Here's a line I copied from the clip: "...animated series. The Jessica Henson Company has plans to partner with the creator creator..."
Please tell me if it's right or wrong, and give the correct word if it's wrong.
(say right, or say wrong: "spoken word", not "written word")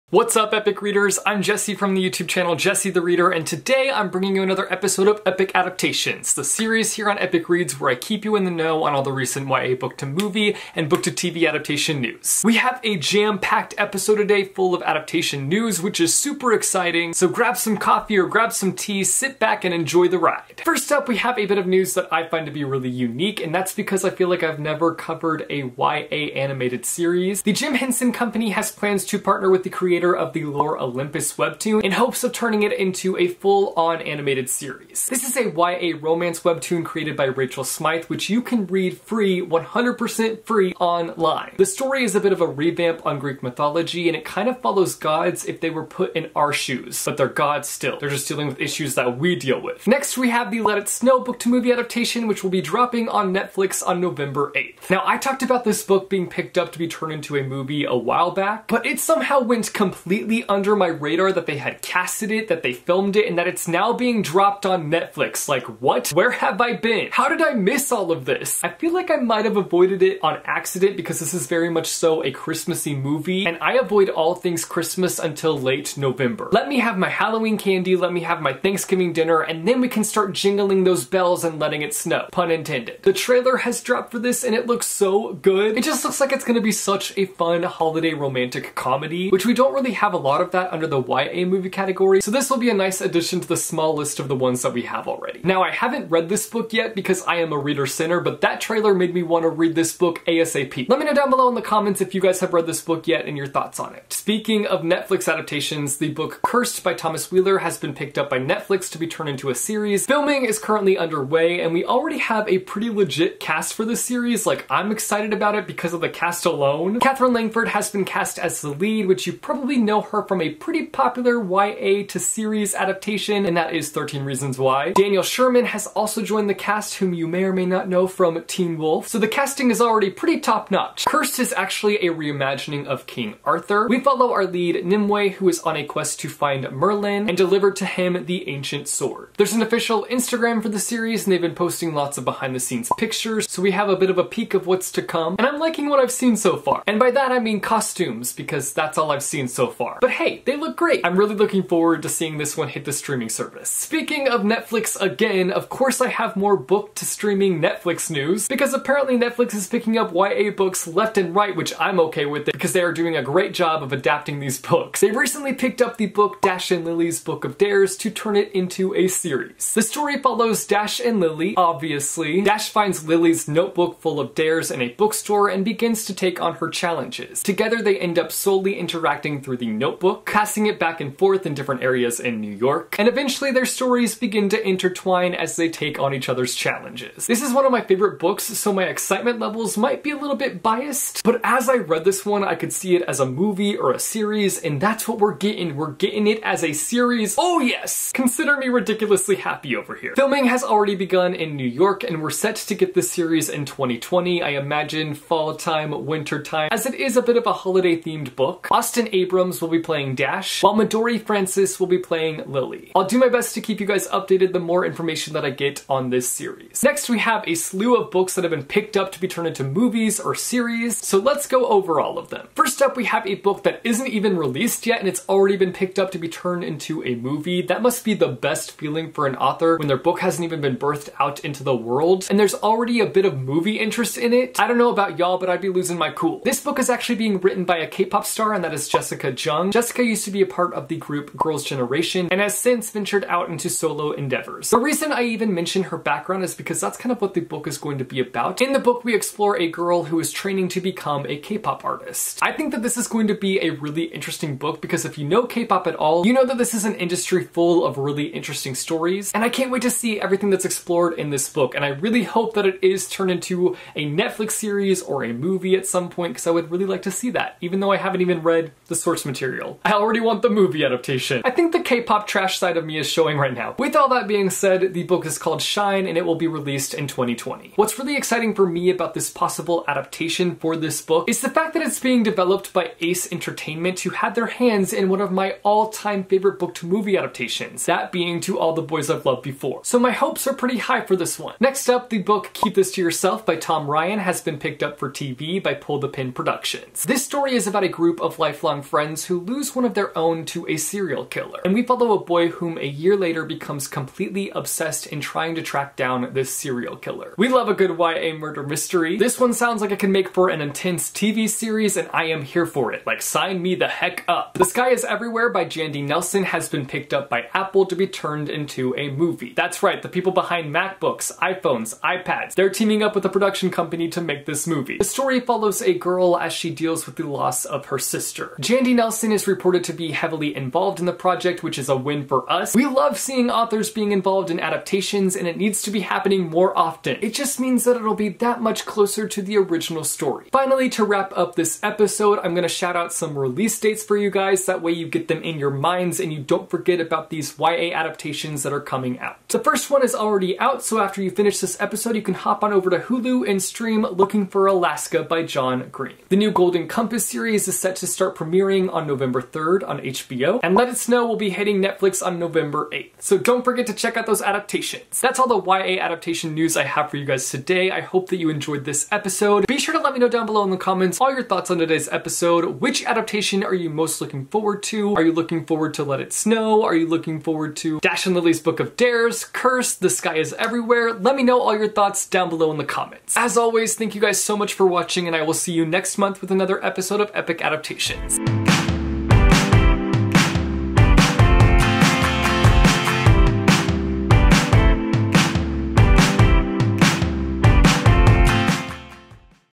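wrong: "Jim", not "Jessica".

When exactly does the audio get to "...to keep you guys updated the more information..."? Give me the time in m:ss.
3:33.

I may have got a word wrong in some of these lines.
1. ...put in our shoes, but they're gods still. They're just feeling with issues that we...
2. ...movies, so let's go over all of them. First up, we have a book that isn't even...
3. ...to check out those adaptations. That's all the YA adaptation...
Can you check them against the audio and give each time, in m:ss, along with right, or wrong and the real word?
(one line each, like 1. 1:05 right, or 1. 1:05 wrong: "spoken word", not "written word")
1. 0:45 wrong: "dealing", not "feeling"
2. 3:40 wrong: "series", not "movies"
3. 6:03 right.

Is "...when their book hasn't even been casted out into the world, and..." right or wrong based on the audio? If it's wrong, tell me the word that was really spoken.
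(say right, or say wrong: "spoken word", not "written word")
wrong: "birthed", not "casted".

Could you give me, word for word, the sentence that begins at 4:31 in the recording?
I think the K-pop trash side of me is showing right now.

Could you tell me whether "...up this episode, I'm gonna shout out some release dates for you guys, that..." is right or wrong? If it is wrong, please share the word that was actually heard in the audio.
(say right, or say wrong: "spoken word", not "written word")
right.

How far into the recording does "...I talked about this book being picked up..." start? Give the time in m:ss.
0:55.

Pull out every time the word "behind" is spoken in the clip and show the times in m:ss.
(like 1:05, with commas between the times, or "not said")
2:22, 5:20.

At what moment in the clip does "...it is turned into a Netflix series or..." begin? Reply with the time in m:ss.
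4:22.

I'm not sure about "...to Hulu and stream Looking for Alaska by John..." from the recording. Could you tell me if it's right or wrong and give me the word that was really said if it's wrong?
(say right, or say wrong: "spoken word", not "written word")
right.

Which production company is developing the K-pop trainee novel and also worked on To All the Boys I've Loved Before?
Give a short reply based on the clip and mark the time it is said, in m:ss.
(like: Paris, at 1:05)
Ace Entertainment, at 4:43.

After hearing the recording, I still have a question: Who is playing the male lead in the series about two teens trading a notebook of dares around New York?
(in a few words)
Austin A. Abrams.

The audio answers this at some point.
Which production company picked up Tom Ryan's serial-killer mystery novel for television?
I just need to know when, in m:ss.
4:55.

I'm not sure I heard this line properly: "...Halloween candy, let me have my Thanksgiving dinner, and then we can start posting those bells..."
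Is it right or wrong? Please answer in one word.
wrong.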